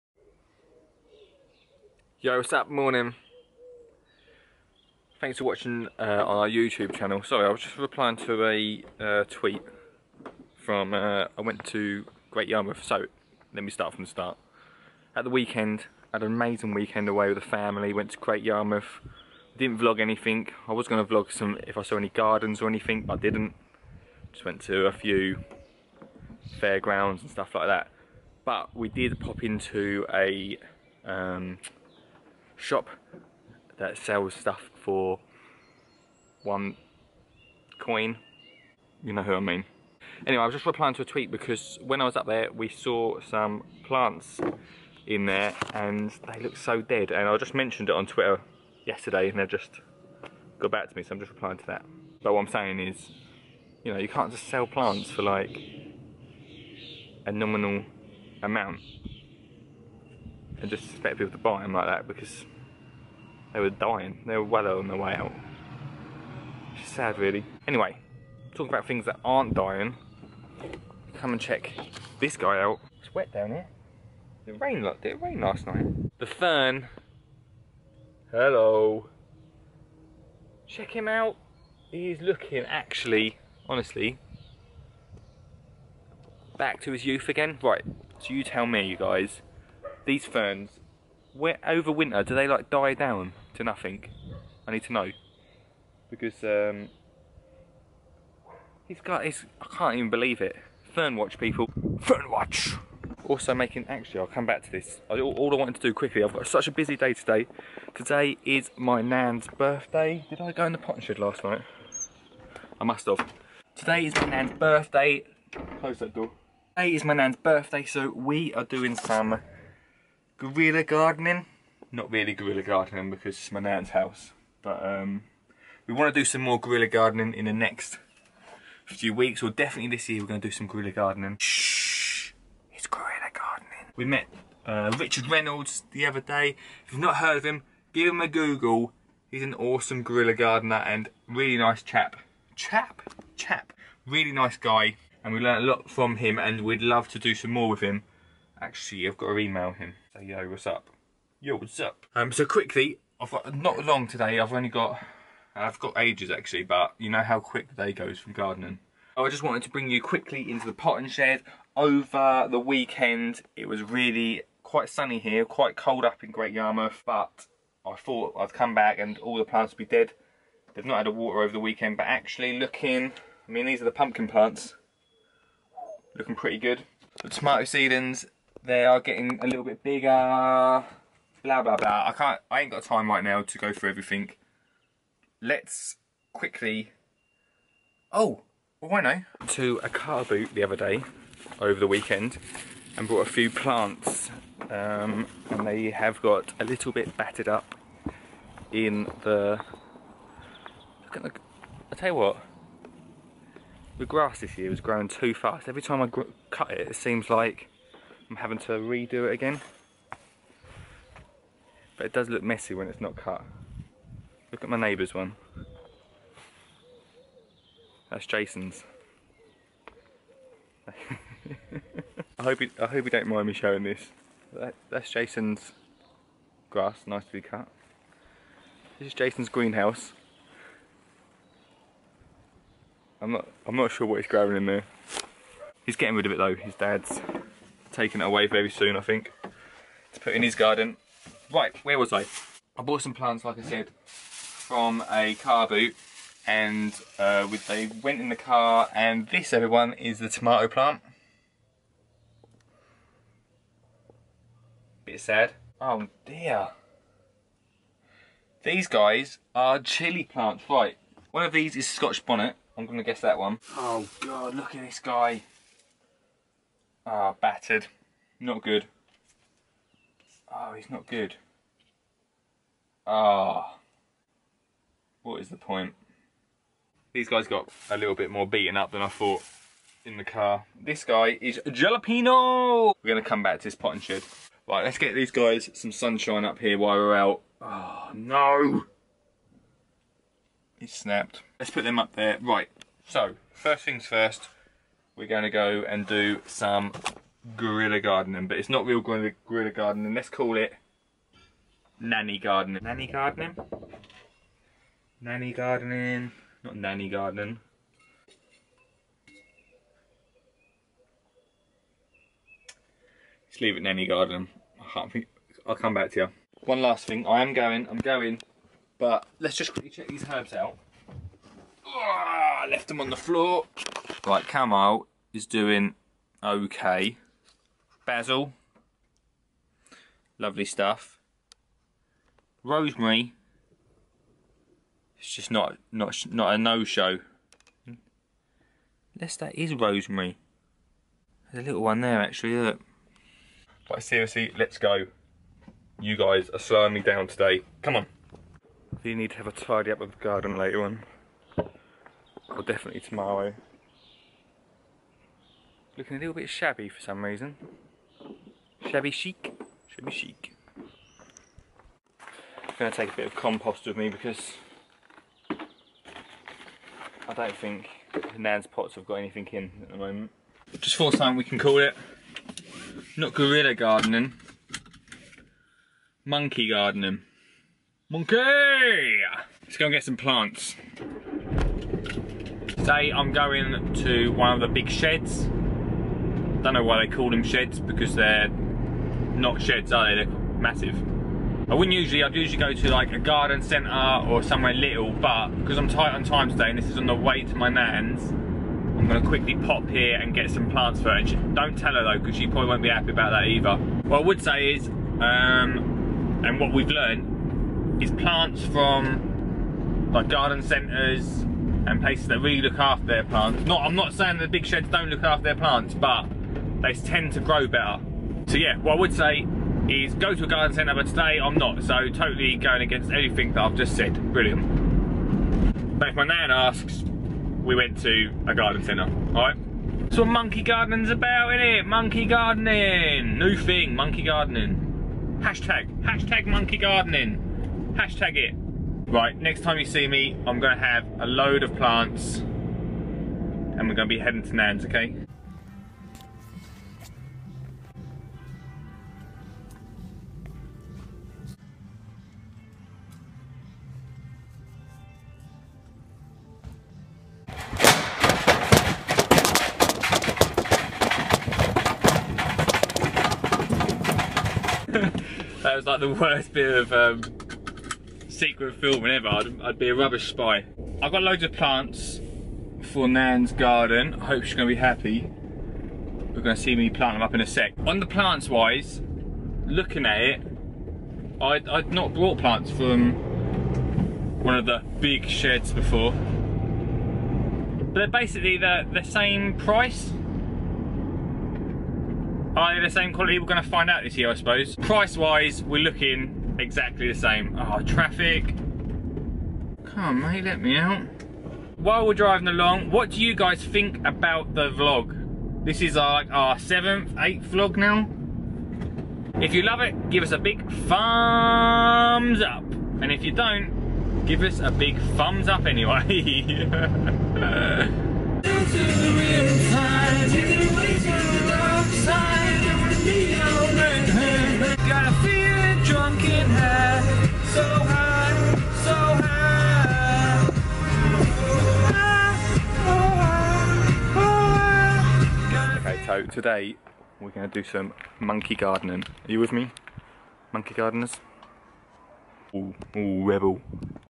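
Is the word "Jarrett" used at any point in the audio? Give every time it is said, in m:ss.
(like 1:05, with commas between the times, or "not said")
not said.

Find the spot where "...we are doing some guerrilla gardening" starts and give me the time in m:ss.
1:58.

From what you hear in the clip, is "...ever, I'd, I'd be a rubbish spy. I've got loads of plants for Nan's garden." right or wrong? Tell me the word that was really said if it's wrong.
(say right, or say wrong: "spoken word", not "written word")
right.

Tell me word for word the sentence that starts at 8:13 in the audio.
We're gonna find out this year, I suppose.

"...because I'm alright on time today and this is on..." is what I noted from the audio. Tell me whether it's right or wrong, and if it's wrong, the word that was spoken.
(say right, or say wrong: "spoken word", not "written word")
wrong: "tight", not "alright".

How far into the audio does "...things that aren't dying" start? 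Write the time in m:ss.
1:08.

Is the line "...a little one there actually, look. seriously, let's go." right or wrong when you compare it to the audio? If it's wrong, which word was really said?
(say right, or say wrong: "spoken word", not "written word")
right.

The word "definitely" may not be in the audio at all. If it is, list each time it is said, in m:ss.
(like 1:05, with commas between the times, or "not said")
2:09, 5:52.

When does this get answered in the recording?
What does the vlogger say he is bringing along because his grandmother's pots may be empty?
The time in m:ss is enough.
6:03.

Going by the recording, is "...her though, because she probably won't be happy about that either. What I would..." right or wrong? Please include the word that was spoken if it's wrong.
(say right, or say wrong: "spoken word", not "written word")
right.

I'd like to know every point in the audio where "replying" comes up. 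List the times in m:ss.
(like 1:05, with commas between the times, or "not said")
0:07, 0:40, 0:51.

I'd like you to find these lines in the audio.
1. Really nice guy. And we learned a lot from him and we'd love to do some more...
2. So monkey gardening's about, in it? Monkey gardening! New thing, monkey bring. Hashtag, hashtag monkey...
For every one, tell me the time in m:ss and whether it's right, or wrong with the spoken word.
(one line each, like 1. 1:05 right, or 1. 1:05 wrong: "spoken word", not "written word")
1. 2:24 right
2. 7:10 wrong: "gardening", not "bring".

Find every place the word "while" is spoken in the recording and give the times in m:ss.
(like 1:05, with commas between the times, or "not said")
4:46, 8:21.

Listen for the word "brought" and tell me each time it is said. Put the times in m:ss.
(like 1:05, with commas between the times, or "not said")
3:13, 8:02.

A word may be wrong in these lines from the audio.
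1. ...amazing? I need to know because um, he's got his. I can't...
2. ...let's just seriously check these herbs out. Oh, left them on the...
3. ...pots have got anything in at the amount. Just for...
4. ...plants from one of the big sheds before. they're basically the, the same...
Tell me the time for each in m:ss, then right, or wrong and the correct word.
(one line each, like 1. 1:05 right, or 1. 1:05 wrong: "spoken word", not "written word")
1. 1:33 wrong: "nothing", not "amazing"
2. 5:19 wrong: "quickly", not "seriously"
3. 6:08 wrong: "moment", not "amount"
4. 8:02 right.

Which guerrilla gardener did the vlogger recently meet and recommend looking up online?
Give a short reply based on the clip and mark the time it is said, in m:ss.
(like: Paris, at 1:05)
Richard Reynolds, at 2:14.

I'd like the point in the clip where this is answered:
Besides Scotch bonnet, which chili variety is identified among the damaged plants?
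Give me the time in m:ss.
4:41.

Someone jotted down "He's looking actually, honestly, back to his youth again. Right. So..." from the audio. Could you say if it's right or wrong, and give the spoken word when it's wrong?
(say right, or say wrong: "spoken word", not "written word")
right.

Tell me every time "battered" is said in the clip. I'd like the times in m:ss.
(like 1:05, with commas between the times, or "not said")
3:17, 4:27.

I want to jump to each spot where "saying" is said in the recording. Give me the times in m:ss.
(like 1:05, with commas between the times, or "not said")
0:52, 6:54.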